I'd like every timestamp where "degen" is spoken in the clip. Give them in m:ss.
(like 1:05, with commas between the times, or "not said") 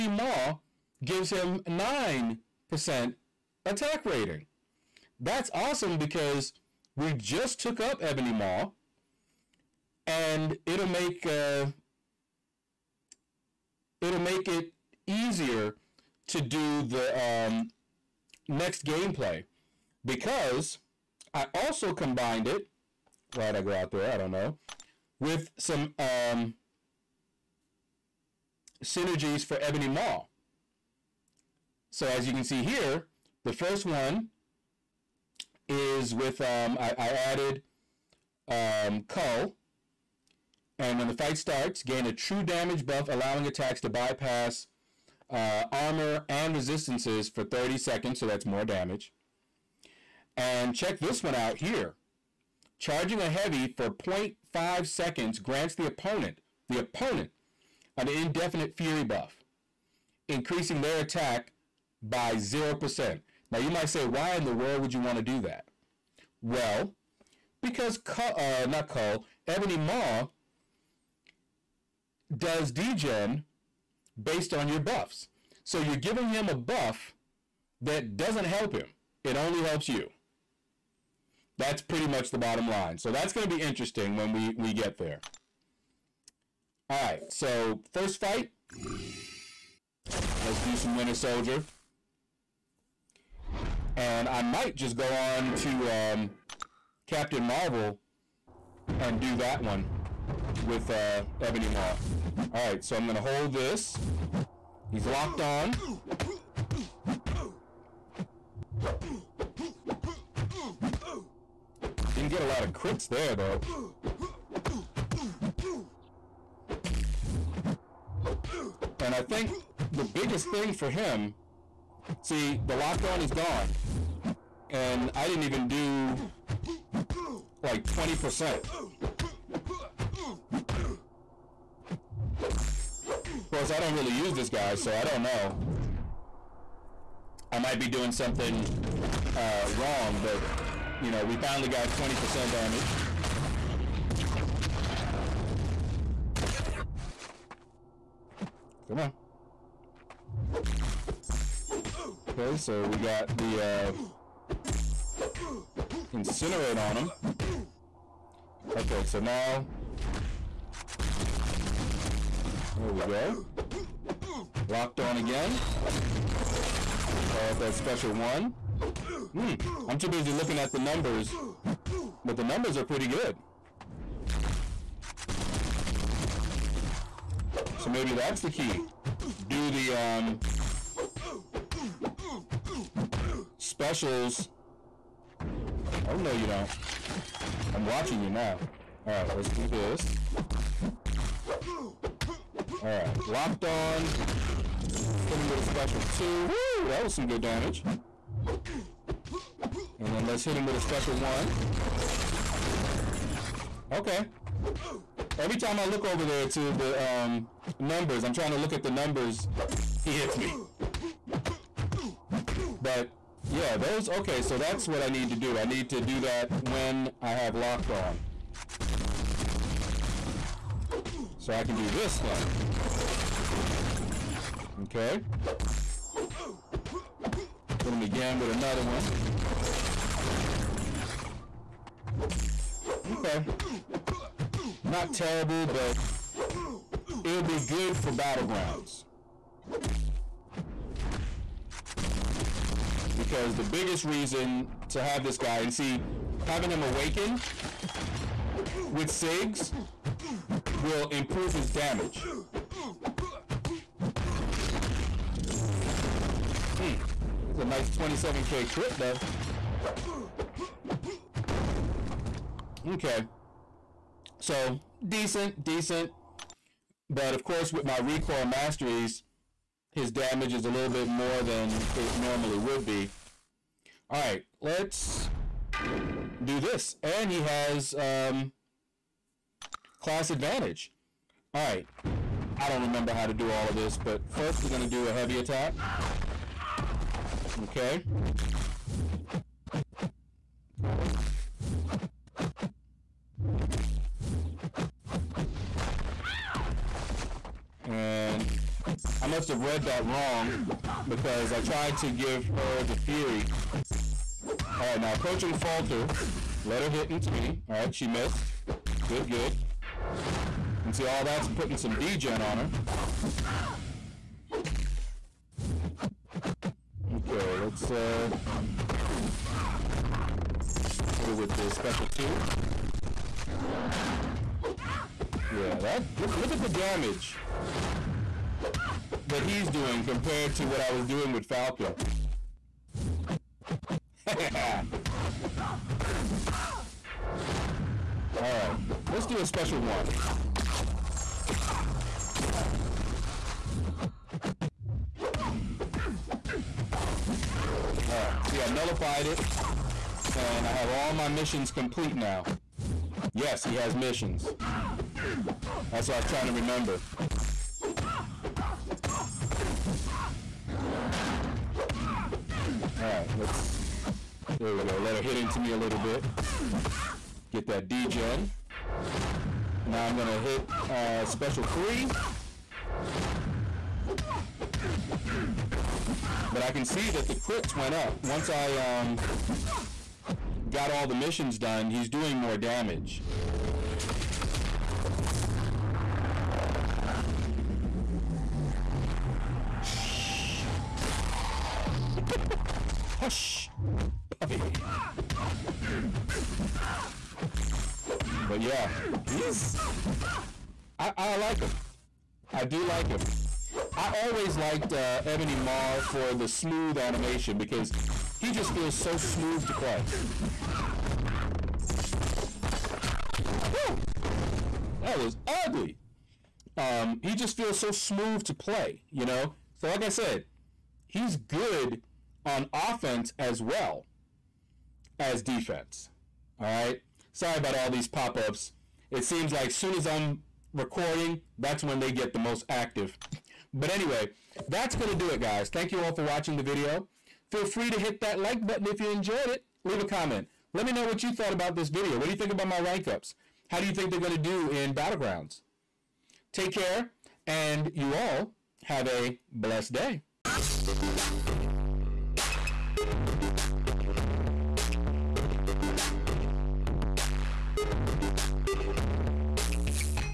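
1:12, 5:11.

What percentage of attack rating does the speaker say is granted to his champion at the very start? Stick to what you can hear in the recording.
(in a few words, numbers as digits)
9%.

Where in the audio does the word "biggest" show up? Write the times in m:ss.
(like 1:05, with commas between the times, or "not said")
2:00, 4:03.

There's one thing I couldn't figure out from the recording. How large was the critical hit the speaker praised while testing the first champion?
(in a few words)
27k.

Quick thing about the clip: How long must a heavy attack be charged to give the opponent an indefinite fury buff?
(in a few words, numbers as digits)
0.5 seconds.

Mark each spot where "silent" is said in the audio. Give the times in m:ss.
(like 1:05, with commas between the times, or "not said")
not said.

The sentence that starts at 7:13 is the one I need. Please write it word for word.
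But anyway, that's going to do it, guys.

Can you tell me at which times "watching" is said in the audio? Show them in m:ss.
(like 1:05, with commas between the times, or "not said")
3:07, 7:16.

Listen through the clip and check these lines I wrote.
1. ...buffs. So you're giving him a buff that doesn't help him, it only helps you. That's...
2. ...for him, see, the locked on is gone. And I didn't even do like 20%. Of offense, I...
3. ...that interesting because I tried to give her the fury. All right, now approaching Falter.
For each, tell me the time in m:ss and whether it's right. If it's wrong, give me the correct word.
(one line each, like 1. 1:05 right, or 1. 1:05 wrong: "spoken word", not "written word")
1. 1:14 right
2. 2:00 wrong: "course", not "offense"
3. 4:59 wrong: "wrong", not "interesting".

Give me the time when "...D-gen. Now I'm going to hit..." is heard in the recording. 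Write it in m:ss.
6:07.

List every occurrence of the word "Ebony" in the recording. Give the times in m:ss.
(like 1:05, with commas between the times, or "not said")
0:08, 0:29, 1:09, 1:41, 6:45.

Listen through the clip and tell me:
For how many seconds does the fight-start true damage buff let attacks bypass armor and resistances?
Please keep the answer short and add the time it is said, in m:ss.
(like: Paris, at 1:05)
30 seconds, at 0:47.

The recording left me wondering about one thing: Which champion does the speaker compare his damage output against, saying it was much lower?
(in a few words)
Falcon.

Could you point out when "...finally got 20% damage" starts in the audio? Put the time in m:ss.
2:21.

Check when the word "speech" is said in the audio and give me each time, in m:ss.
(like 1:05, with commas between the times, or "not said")
not said.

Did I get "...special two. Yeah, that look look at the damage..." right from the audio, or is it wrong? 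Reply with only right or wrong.
right.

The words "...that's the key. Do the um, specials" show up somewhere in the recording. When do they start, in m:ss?
2:58.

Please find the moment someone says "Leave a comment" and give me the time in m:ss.
7:19.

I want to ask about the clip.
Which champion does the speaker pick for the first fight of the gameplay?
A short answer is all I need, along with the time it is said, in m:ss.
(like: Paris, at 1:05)
Winter Soldier, at 1:30.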